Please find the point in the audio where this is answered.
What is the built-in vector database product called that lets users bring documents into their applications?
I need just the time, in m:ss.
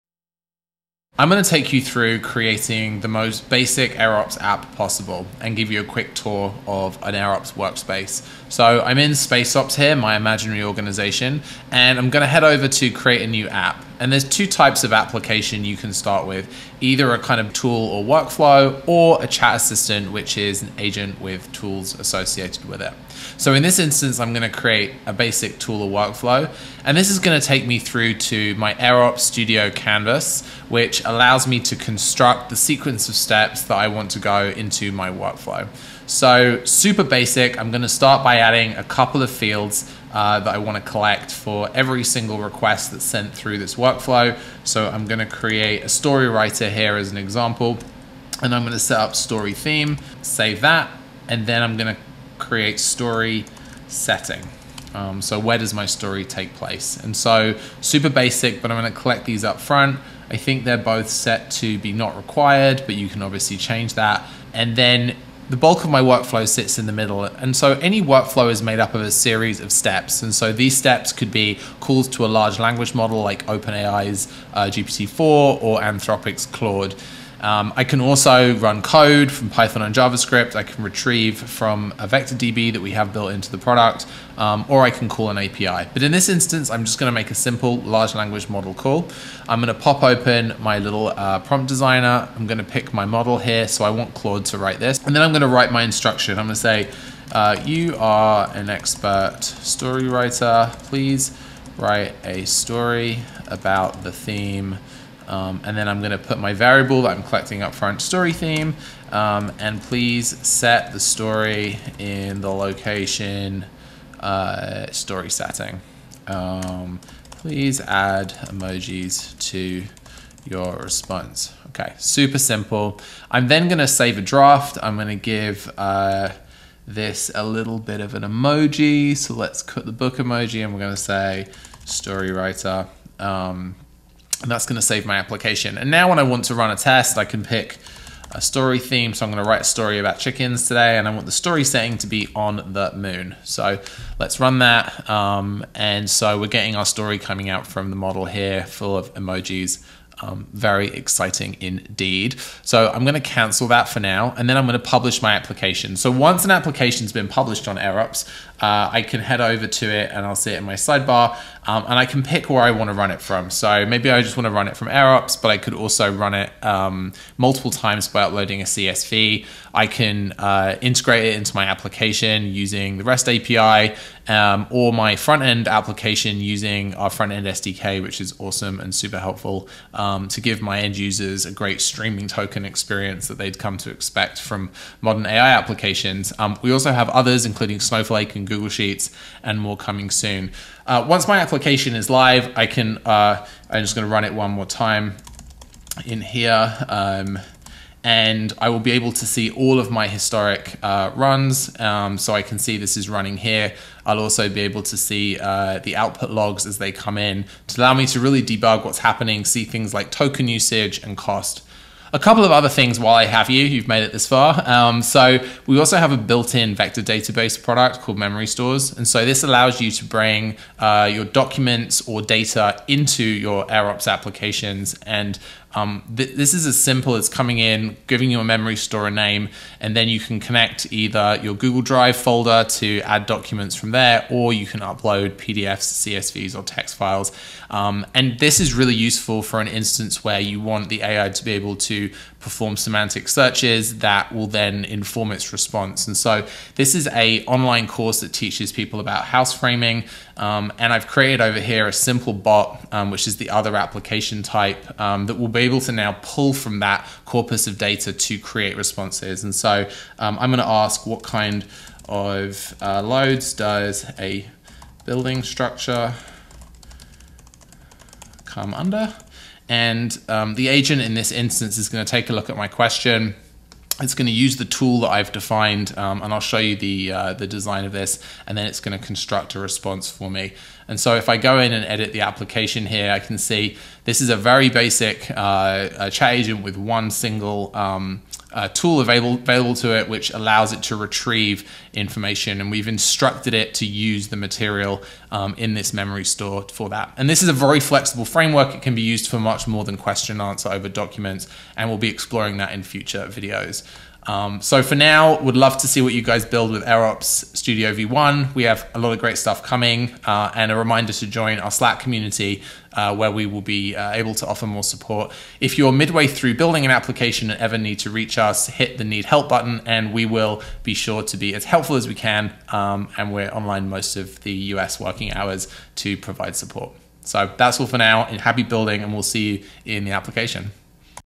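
3:38.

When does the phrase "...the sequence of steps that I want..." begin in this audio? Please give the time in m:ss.
0:32.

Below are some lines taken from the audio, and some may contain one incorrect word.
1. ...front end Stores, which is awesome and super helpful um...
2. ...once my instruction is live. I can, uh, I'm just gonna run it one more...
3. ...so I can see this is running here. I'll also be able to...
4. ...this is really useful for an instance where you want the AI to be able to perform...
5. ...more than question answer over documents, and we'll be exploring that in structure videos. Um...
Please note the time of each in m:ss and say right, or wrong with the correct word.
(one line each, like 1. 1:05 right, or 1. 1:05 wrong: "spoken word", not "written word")
1. 2:57 wrong: "SDK", not "Stores"
2. 3:11 wrong: "application", not "instruction"
3. 3:22 right
4. 3:58 right
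5. 4:59 wrong: "future", not "structure".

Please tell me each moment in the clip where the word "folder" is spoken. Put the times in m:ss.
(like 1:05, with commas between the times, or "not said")
3:52.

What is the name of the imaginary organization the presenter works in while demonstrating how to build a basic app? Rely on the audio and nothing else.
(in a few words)
SpaceOps.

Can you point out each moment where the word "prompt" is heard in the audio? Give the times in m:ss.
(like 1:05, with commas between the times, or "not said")
1:31.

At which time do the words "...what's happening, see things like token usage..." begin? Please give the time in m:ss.
3:28.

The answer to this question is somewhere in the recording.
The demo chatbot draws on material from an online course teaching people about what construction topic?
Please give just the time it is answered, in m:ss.
4:09.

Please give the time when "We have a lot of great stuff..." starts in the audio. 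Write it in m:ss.
5:08.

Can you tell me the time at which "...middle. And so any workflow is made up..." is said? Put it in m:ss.
1:06.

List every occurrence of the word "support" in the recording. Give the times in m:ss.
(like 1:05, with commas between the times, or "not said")
5:14, 5:26.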